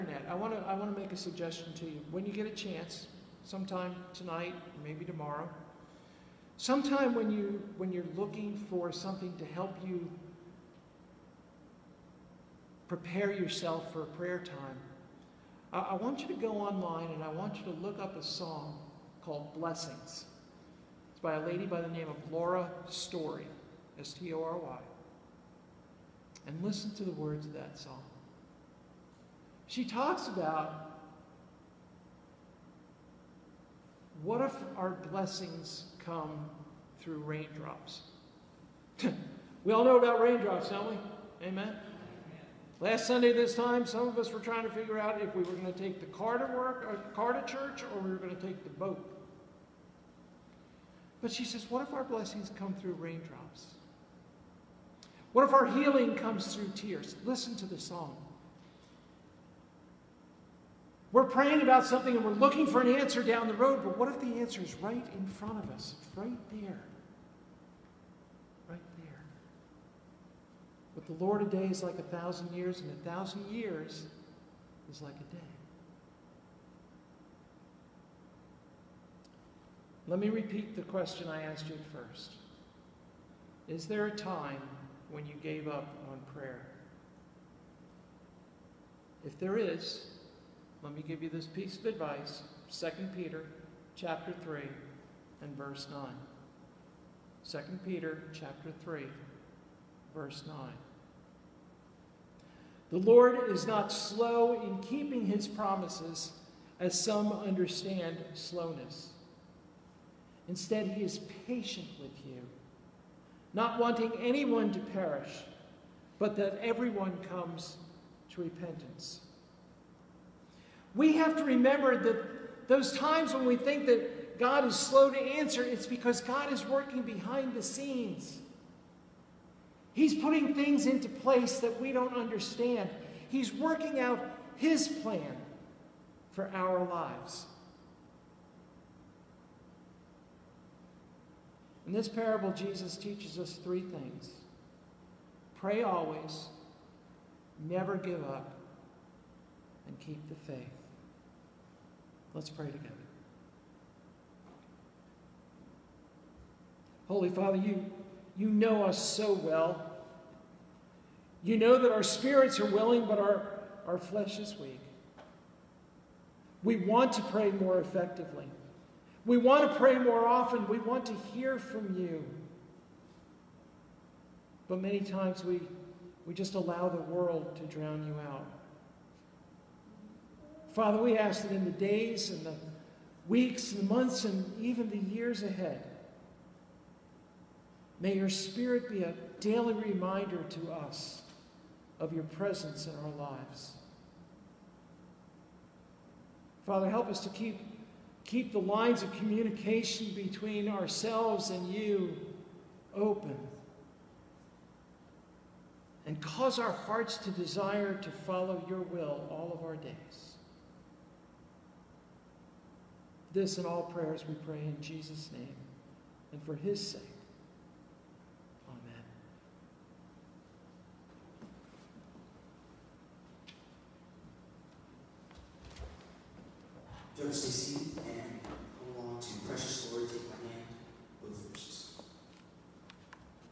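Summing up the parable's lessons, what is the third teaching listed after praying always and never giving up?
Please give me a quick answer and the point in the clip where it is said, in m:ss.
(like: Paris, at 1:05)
keep the faith, at 2:29.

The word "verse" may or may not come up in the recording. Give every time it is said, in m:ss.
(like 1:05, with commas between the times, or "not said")
1:35, 1:40.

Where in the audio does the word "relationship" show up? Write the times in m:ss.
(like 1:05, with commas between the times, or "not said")
not said.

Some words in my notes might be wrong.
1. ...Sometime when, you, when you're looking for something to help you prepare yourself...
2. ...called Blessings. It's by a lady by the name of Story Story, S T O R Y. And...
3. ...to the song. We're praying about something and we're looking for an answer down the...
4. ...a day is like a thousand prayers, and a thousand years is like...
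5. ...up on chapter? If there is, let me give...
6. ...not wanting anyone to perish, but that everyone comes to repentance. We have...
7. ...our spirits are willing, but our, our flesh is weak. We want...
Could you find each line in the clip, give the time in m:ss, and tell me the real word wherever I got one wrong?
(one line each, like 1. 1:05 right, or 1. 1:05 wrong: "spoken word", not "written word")
1. 0:06 right
2. 0:19 wrong: "Laura", not "Story"
3. 0:57 right
4. 1:11 wrong: "years", not "prayers"
5. 1:25 wrong: "prayer", not "chapter"
6. 1:53 right
7. 2:41 right.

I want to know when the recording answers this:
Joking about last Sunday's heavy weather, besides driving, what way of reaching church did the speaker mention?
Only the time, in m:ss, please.
0:48.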